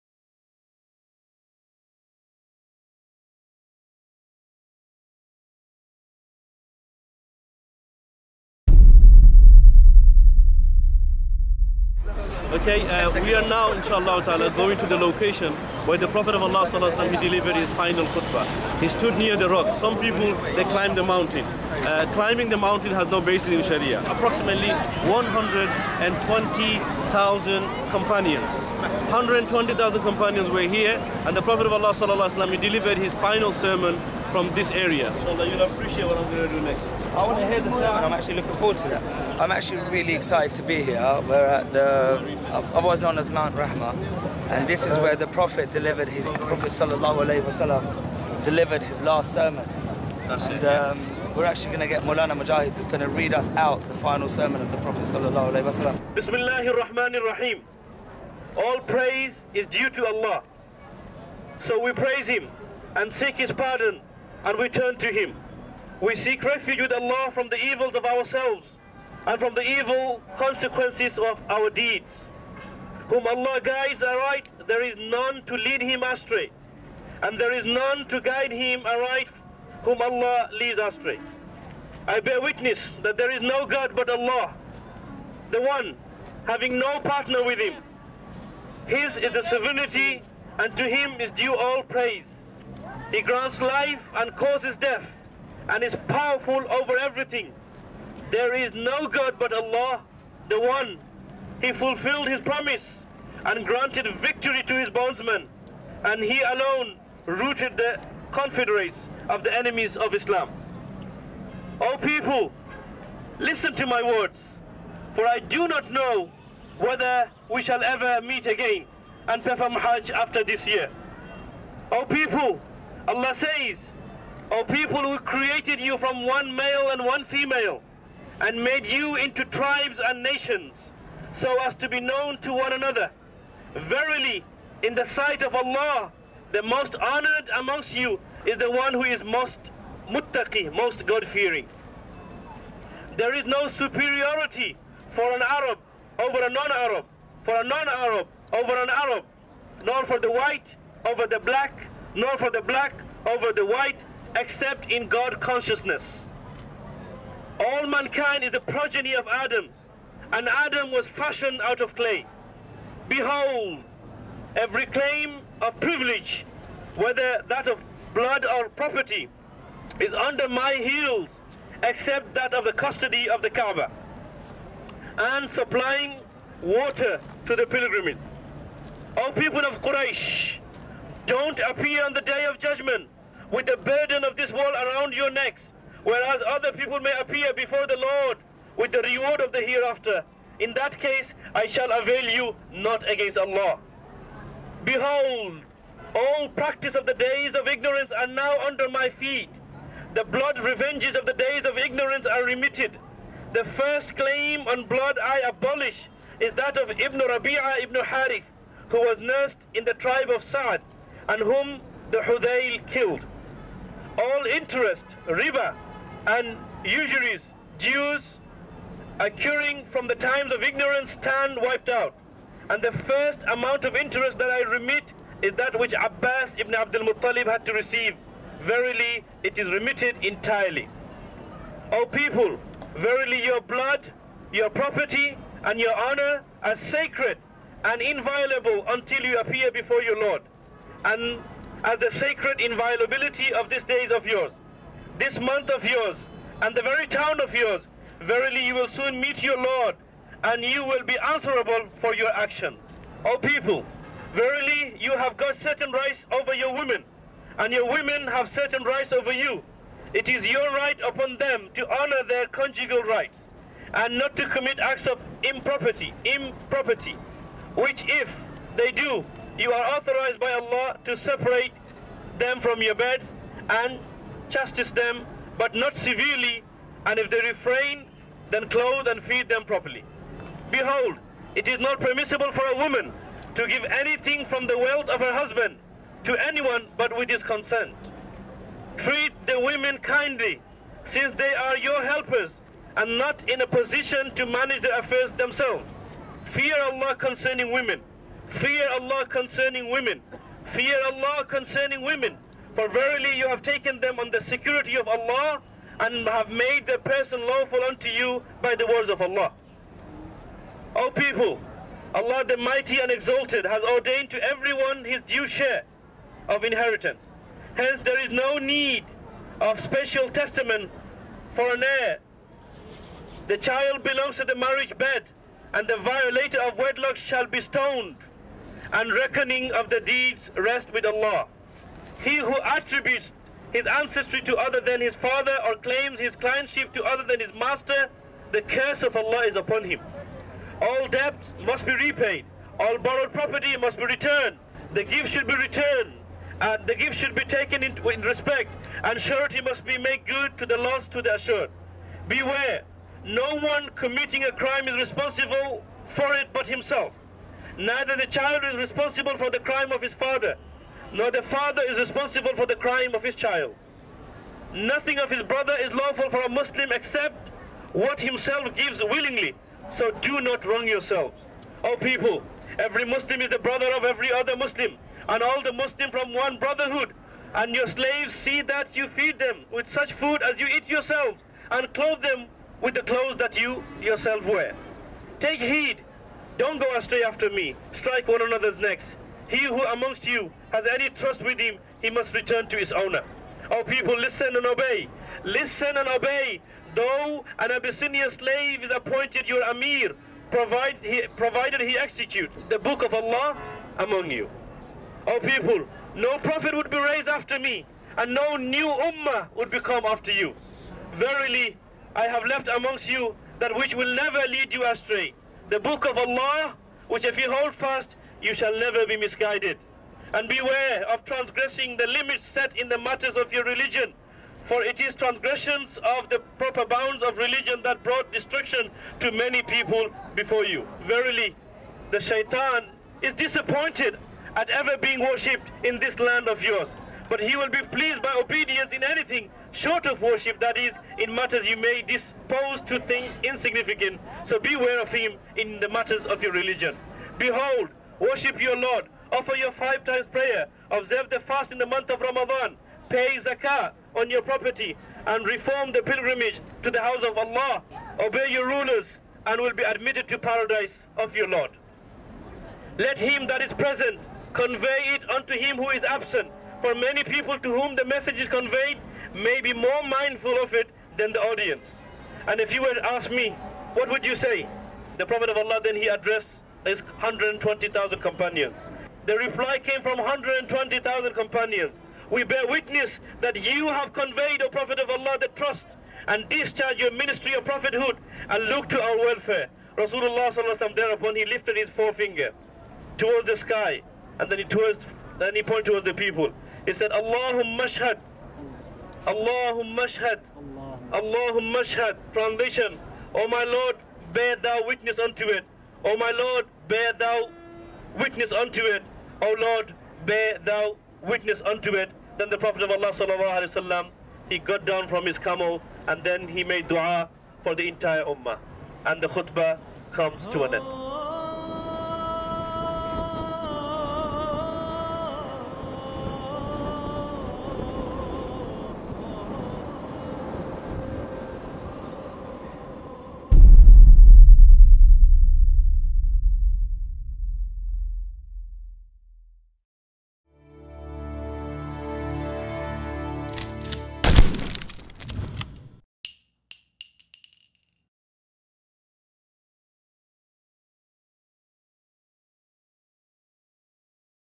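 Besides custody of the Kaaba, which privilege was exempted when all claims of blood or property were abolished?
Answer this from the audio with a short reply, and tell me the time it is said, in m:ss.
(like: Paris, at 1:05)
supplying water to the pilgrimage, at 2:55.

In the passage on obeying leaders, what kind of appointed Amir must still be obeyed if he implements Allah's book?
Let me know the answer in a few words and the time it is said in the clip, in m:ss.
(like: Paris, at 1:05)
an Abyssinian slave, at 6:37.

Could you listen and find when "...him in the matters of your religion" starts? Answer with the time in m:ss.
7:25.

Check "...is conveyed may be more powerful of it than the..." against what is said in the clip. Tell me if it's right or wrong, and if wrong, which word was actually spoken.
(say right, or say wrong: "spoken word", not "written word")
wrong: "mindful", not "powerful".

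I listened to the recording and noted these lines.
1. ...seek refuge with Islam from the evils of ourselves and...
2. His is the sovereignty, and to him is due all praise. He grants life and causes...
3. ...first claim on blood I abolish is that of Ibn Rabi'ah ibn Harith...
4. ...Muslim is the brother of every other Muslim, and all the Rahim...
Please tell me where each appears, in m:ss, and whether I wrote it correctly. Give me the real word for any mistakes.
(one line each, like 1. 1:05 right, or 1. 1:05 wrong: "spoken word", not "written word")
1. 1:06 wrong: "Allah", not "Islam"
2. 1:28 right
3. 3:23 right
4. 6:13 wrong: "Muslim", not "Rahim".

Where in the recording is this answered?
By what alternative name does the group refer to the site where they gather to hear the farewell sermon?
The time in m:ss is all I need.
0:43.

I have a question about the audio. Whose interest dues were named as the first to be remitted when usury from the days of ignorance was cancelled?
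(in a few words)
Abbas ibn Abdul Muttalib.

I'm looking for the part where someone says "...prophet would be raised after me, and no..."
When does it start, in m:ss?
6:46.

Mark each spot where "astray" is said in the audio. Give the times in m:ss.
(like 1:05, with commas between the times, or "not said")
1:16, 1:20, 6:26, 6:54.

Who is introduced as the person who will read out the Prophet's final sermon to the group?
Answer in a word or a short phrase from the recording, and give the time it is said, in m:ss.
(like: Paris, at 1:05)
Mulana Mujahid, at 0:52.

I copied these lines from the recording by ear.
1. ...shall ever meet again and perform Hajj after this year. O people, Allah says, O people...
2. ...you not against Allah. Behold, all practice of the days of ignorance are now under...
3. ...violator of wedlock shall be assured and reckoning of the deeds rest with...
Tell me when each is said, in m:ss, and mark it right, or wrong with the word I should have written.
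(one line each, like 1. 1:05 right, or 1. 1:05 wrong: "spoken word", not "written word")
1. 1:57 right
2. 3:12 right
3. 5:25 wrong: "stoned", not "assured".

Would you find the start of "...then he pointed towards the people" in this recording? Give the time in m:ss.
8:15.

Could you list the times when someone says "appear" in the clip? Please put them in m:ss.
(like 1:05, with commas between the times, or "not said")
3:01, 3:07, 3:59.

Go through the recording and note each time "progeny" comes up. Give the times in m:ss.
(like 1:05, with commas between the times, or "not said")
2:38.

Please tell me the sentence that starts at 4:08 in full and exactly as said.
Verily you will soon meet your Lord, and you will be answerable for your actions.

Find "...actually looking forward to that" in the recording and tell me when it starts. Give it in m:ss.
0:38.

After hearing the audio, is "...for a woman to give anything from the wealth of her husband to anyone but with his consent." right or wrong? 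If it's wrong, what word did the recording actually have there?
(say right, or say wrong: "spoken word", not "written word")
right.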